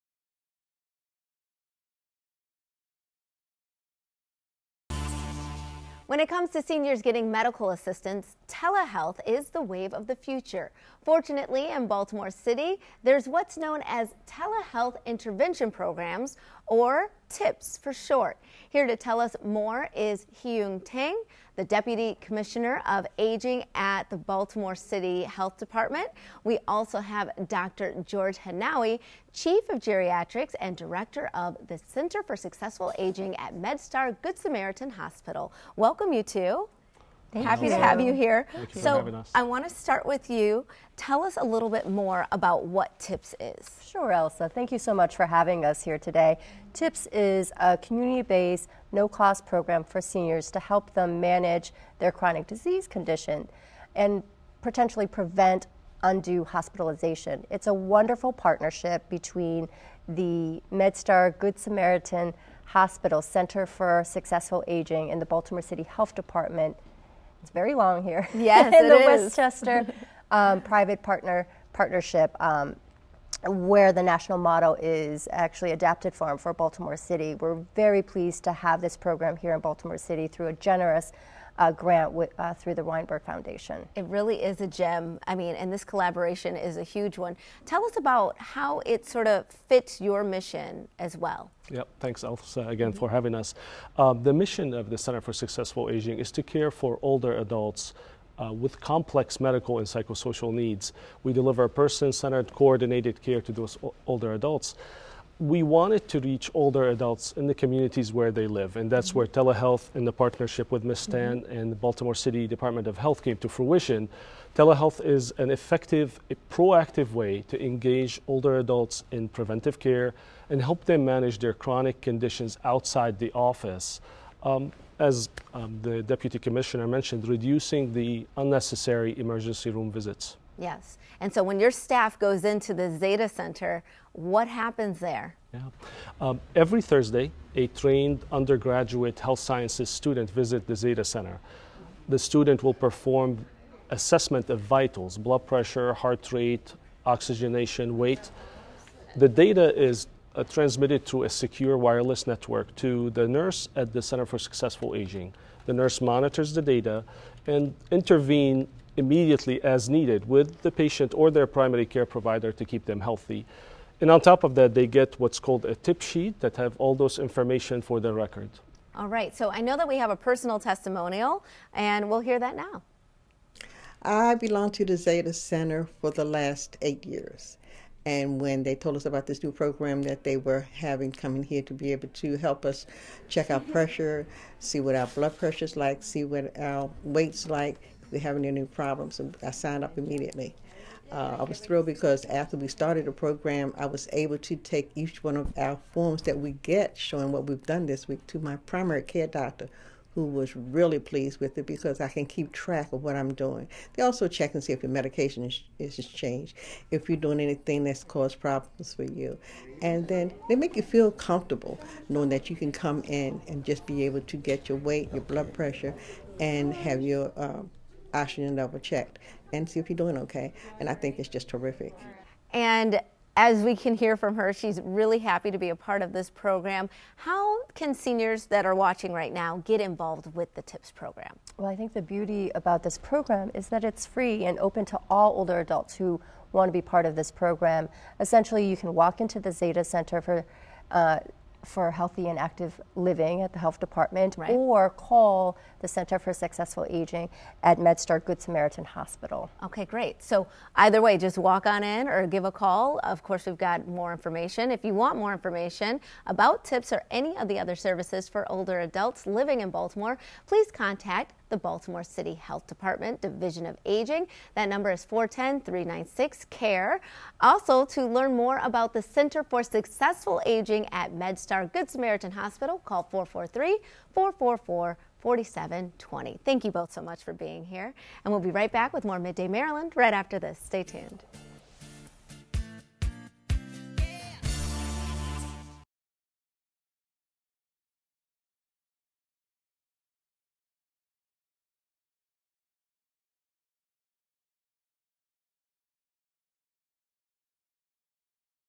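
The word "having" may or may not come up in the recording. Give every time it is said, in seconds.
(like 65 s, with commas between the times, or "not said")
45 s, 93 s, 180 s, 188 s.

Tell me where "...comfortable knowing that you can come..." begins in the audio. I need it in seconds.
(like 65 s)
211 s.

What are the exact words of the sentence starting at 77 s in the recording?
We're very pleased to have this program here in Baltimore City through a generous uh, grant with, uh, through the Weinberg Foundation.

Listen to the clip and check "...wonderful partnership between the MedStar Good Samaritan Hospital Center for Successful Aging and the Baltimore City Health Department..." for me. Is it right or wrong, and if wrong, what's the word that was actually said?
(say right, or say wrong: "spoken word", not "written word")
right.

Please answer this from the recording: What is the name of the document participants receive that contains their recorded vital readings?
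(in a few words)
tip sheet.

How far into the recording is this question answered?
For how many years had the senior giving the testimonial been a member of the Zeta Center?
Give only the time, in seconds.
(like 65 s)
176 s.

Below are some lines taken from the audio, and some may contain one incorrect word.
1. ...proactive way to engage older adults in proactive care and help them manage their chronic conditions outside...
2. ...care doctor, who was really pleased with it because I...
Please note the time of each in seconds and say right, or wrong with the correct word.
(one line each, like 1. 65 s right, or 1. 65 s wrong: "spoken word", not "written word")
1. 116 s wrong: "preventive", not "proactive"
2. 199 s right.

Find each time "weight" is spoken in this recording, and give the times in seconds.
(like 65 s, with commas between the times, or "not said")
147 s, 187 s, 214 s.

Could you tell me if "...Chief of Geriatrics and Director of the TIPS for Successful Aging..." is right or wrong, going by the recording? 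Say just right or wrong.
wrong.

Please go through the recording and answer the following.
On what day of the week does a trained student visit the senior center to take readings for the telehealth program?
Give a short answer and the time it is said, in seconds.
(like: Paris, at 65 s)
Thursday, at 136 s.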